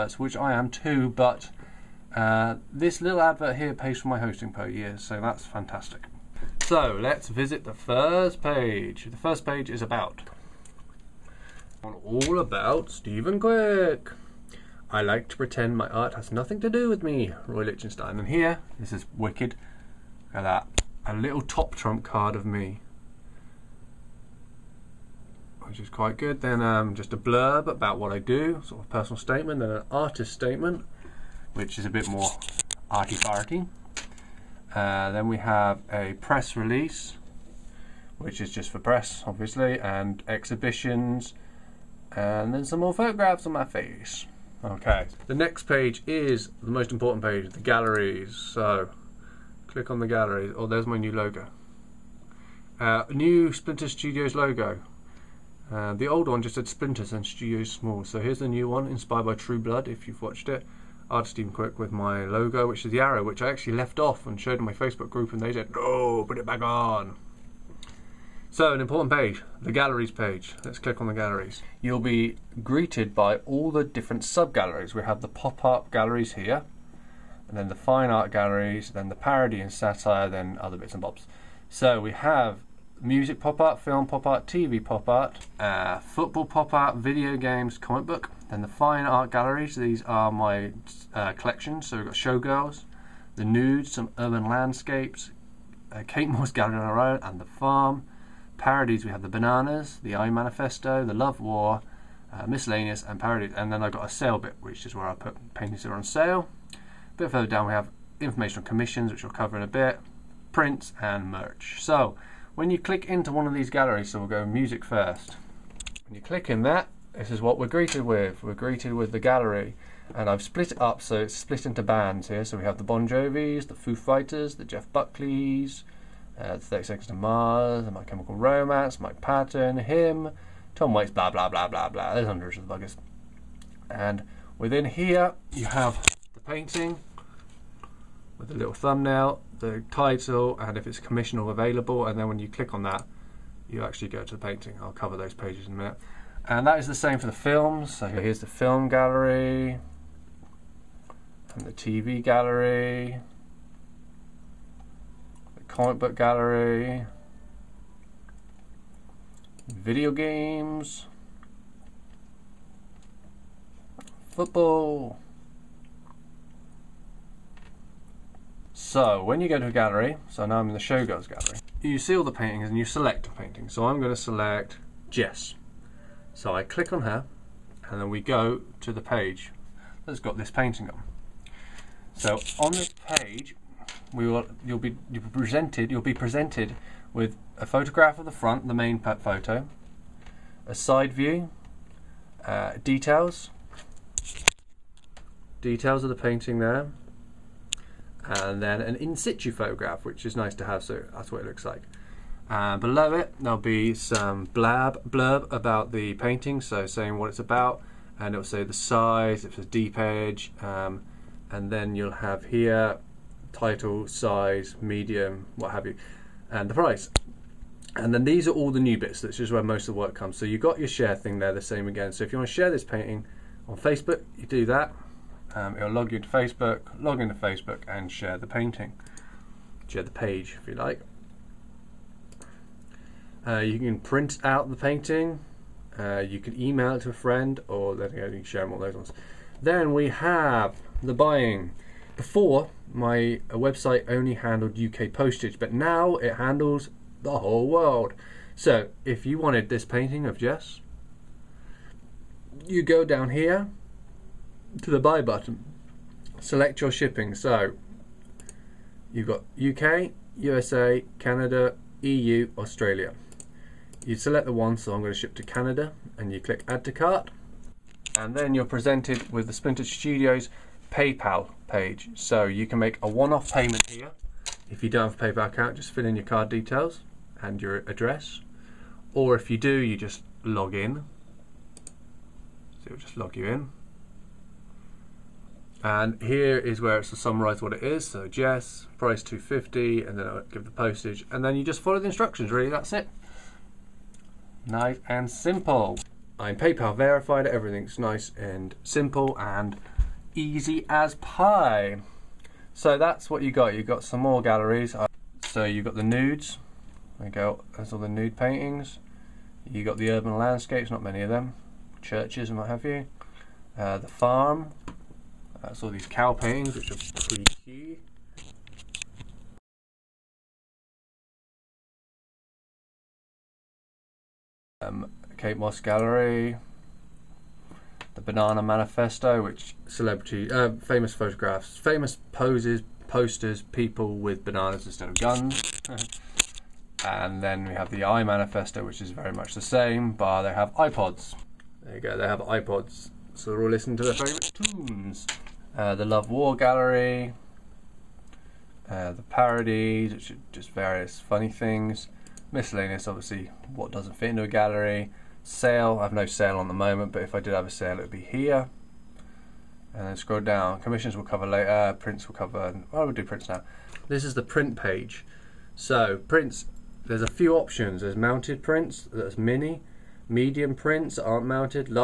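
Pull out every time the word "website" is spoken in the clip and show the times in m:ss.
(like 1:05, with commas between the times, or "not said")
4:03.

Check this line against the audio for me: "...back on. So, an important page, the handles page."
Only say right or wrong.
wrong.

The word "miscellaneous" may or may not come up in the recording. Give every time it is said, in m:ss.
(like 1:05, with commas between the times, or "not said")
1:42, 5:52.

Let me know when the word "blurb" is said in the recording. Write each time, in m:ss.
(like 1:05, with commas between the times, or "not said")
0:27, 3:25.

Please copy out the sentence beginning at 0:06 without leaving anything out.
So let's visit the first page.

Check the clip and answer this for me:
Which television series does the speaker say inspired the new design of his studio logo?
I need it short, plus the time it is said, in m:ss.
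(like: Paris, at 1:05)
True Blood, at 0:59.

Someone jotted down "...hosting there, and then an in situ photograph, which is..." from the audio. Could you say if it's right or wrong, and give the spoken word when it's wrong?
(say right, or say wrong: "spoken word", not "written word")
wrong: "painting", not "hosting".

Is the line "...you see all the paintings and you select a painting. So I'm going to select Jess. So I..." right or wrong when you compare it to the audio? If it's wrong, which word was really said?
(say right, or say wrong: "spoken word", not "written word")
right.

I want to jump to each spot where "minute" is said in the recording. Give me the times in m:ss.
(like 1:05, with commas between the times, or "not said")
2:25.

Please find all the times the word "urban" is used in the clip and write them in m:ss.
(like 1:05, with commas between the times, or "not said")
1:34, 5:10.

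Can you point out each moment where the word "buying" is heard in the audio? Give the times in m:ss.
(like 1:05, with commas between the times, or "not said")
4:01.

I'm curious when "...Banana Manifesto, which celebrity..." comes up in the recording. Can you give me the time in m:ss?
5:28.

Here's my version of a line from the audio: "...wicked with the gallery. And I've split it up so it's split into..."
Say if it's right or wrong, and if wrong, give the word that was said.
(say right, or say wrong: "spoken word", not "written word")
wrong: "greeted", not "wicked".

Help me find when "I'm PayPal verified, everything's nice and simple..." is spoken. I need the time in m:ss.
4:56.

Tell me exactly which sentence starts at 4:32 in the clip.
So you can make a one-off payment here.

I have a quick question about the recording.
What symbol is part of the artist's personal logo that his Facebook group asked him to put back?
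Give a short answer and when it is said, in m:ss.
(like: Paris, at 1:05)
The arrow, at 1:02.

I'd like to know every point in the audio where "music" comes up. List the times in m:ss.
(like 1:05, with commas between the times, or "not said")
1:22, 1:54.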